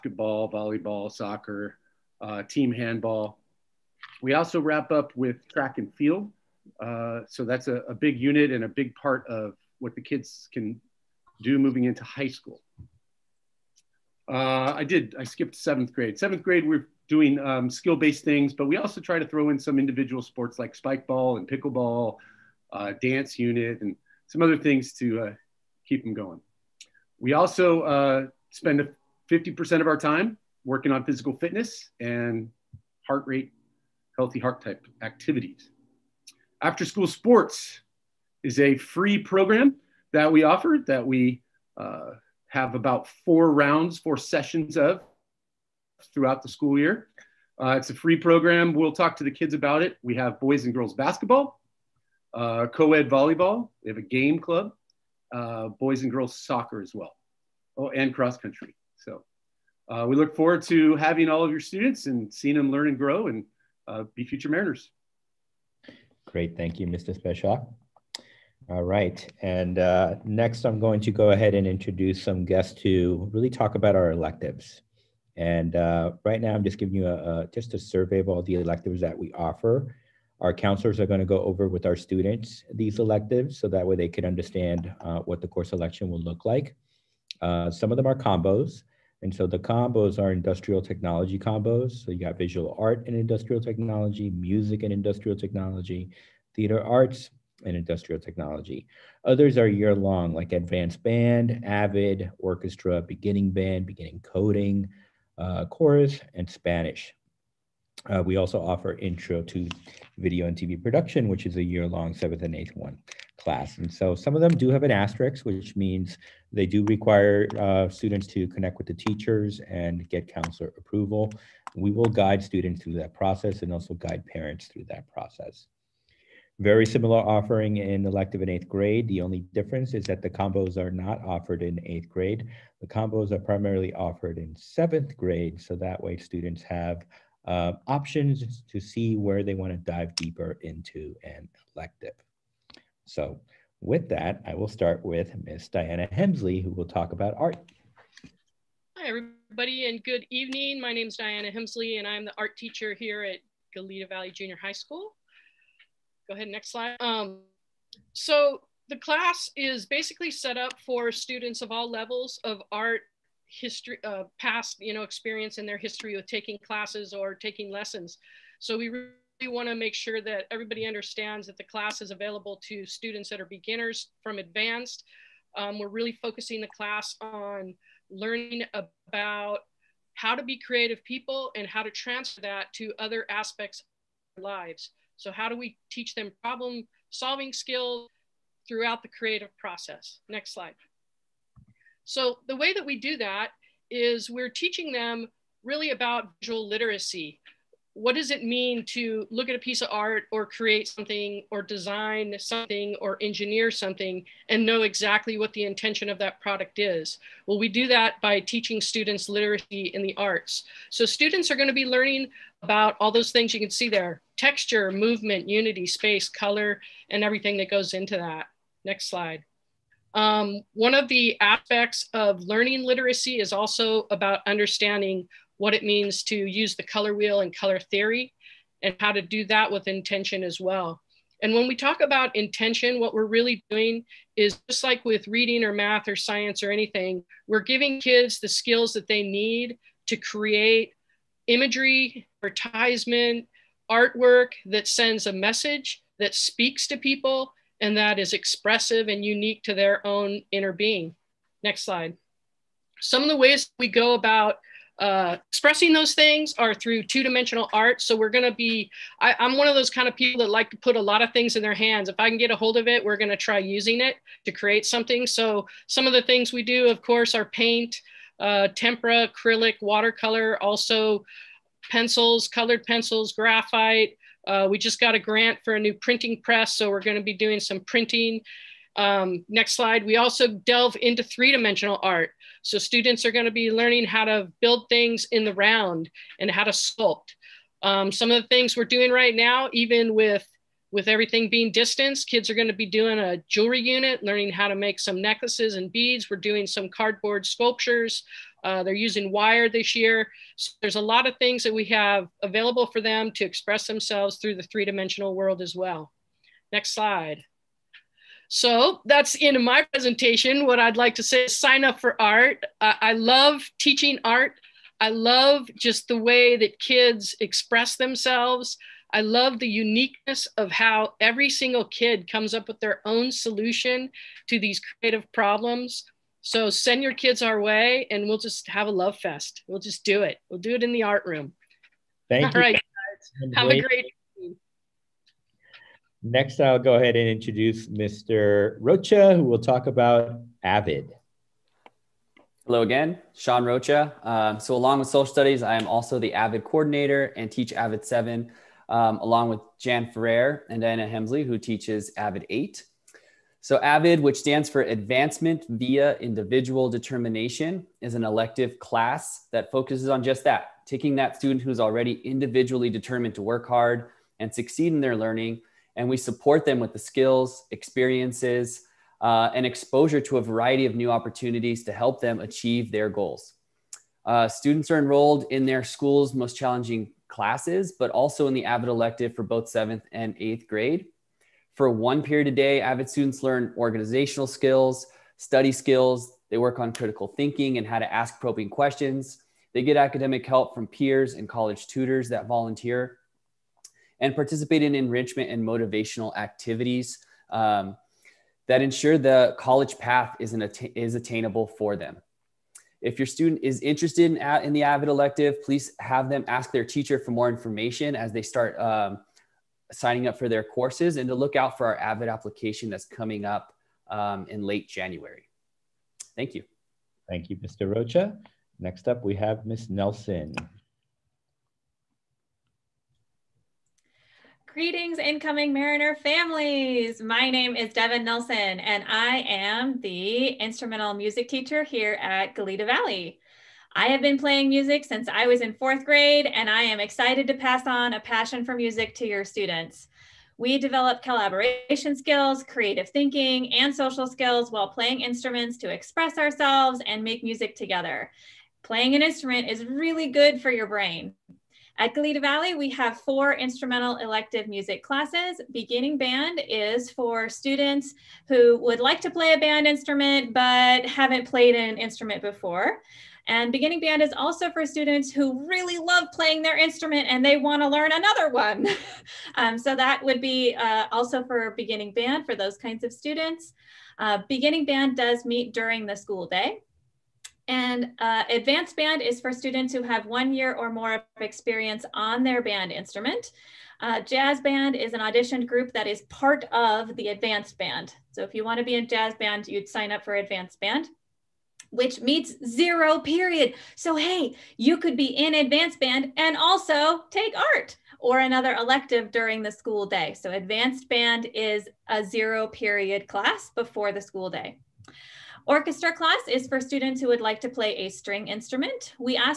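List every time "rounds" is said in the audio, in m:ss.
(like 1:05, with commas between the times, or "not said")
0:43, 4:45.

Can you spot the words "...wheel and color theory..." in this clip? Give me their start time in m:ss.
3:47.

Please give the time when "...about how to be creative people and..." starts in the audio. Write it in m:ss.
2:58.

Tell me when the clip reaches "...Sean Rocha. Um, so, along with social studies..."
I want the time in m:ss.
5:43.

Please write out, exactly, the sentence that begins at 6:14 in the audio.
Uh, students are enrolled in their school's most challenging classes, but also in the AVID elective for both seventh and eighth grade.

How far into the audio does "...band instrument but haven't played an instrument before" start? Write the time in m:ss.
7:39.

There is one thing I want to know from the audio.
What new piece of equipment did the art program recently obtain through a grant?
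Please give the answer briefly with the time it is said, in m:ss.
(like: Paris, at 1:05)
Printing press, at 4:35.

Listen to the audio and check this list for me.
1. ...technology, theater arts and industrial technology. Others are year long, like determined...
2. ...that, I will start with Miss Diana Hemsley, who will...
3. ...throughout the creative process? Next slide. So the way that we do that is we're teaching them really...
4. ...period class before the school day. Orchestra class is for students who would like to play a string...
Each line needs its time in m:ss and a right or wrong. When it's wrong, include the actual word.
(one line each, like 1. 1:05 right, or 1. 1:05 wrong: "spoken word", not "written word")
1. 1:35 wrong: "advanced", not "determined"
2. 2:24 right
3. 3:08 right
4. 8:22 right.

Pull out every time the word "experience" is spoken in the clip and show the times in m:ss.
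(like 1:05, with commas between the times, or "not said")
2:45, 6:07, 8:01.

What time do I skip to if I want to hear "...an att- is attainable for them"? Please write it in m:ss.
6:40.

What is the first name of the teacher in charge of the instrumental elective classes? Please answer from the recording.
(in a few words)
Devin.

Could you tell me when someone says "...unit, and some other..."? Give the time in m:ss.
0:23.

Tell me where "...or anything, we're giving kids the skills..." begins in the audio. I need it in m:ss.
3:56.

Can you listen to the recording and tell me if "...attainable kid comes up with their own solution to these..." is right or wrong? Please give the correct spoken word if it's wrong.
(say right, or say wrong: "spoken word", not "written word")
wrong: "single", not "attainable".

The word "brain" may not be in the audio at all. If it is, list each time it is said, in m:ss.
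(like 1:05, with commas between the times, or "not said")
7:30.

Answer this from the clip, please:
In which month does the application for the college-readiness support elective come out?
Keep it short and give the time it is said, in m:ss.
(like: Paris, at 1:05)
January, at 6:54.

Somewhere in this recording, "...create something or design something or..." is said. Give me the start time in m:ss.
3:20.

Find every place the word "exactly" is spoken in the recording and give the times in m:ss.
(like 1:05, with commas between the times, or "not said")
3:24.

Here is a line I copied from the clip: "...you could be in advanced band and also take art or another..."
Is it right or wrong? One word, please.
right.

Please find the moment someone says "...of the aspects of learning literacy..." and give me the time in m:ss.
3:40.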